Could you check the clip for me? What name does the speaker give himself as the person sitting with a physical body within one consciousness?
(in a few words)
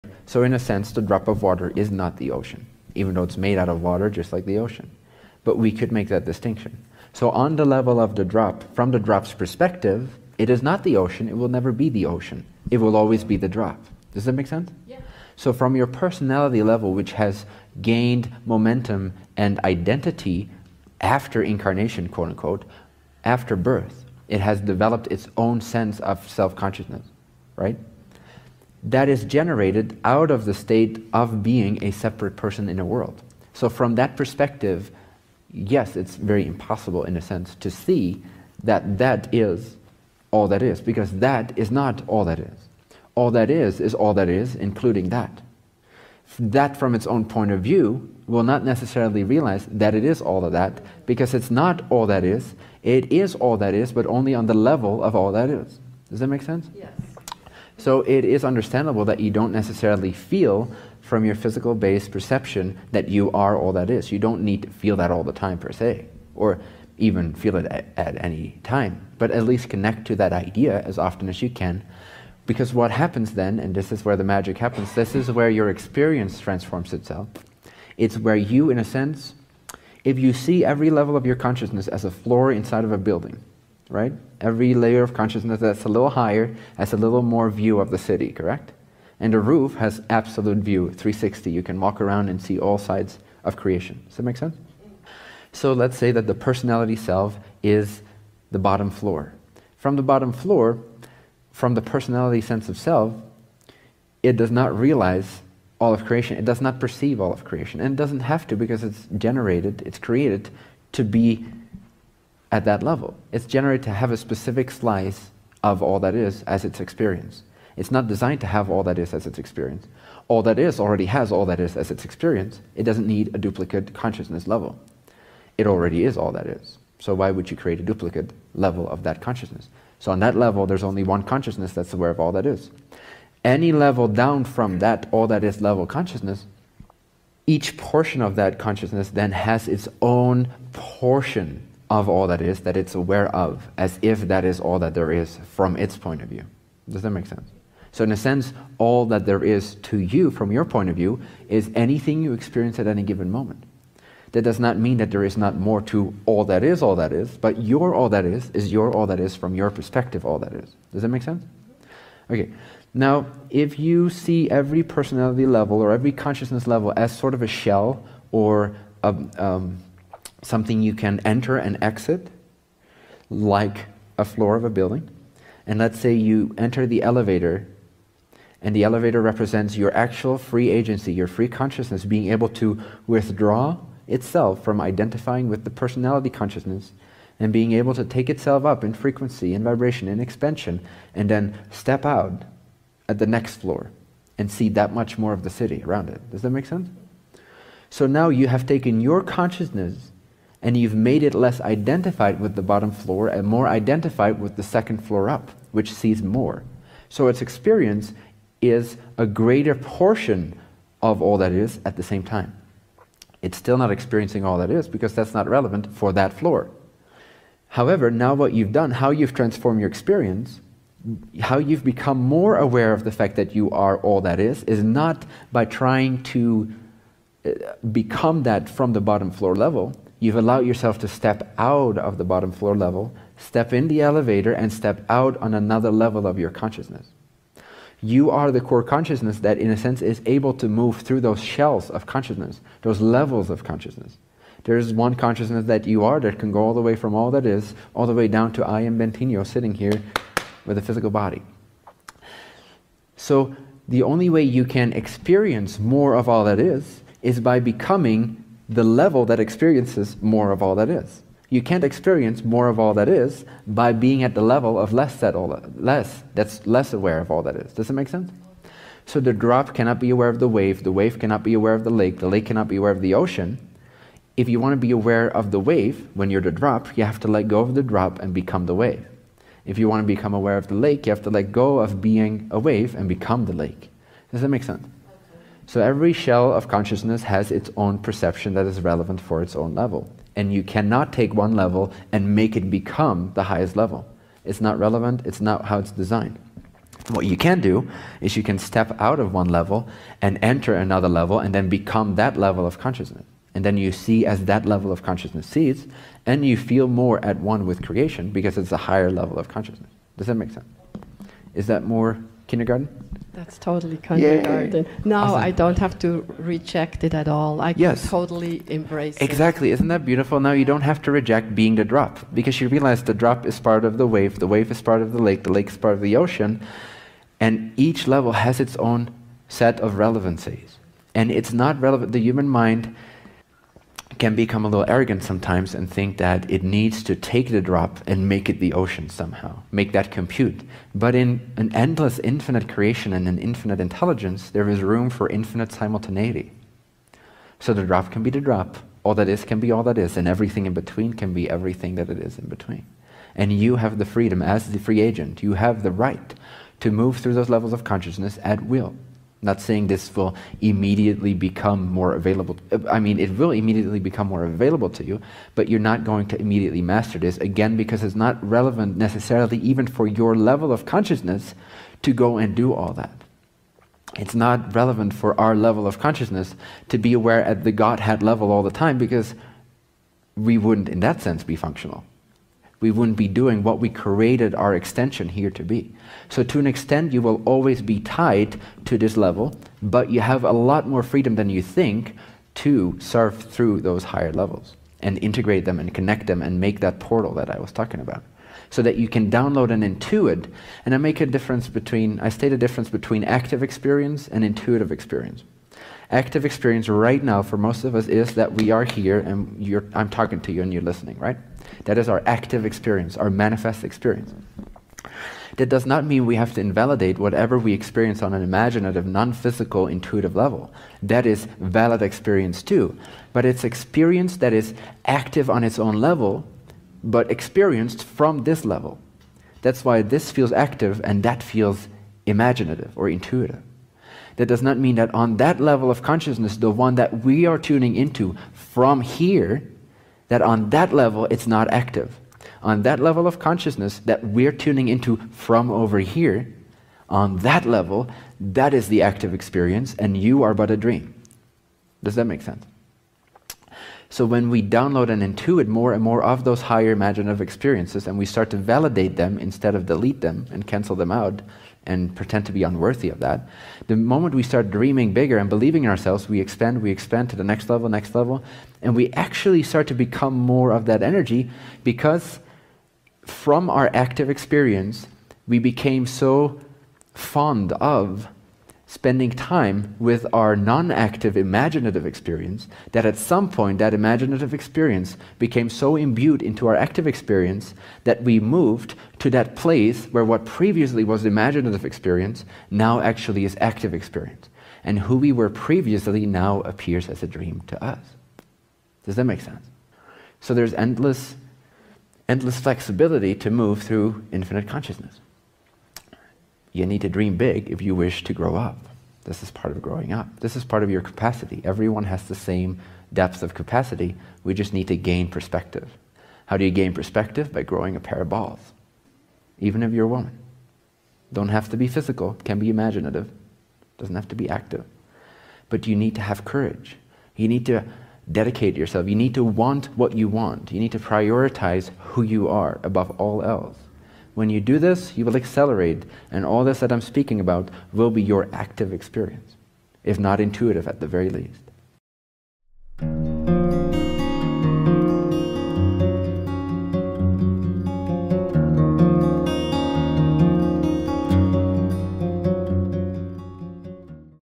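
Bentinho.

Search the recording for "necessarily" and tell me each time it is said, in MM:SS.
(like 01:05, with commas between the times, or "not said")
00:48, 00:59, 06:08.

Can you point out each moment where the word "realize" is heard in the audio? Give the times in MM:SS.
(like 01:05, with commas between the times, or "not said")
00:49, 01:44, 05:22.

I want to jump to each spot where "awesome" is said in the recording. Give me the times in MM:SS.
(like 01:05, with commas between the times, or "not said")
05:15.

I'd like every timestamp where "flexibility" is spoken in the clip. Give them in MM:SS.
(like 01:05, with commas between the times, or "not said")
08:22.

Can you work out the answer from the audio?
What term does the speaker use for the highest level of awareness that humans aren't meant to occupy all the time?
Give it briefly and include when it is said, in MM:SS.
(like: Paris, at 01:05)
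Godhead level, at 06:17.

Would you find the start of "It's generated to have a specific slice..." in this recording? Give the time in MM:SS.
01:53.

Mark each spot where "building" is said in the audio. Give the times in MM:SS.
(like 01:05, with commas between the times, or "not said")
01:22, 02:54.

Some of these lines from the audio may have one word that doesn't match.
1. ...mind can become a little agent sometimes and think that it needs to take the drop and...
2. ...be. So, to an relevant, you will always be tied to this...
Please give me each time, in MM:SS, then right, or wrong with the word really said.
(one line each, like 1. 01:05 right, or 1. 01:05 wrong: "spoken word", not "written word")
1. 05:32 wrong: "arrogant", not "agent"
2. 06:25 wrong: "extent", not "relevant".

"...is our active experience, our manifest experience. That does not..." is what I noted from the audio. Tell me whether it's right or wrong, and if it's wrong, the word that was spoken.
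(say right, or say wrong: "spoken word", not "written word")
right.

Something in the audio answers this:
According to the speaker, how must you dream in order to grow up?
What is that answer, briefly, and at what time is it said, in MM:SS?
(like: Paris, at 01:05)
big, at 08:27.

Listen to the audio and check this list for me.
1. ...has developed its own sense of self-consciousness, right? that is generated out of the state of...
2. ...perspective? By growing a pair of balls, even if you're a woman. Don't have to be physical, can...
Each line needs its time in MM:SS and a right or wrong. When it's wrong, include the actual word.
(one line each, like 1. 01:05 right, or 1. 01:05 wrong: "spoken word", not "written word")
1. 00:24 right
2. 08:36 right.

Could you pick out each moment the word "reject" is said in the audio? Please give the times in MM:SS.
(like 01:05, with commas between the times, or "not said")
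05:16, 05:21.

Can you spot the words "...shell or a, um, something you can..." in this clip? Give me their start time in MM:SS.
02:47.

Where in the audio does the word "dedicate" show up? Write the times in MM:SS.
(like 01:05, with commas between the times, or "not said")
08:48.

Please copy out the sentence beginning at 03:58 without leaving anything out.
You are the core consciousness that, in a sense, is able to move through those shells of consciousness, those levels of consciousness.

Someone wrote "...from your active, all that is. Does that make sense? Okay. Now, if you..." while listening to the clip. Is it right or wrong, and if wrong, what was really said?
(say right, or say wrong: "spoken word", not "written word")
wrong: "perspective", not "active".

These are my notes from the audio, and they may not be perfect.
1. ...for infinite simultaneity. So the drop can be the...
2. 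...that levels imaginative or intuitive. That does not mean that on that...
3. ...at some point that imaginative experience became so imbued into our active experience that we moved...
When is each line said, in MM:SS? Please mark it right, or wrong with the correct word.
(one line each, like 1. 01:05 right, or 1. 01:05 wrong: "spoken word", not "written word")
1. 05:45 right
2. 07:11 wrong: "feels", not "levels"
3. 08:03 right.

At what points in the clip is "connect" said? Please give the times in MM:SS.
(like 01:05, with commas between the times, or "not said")
01:09, 06:35.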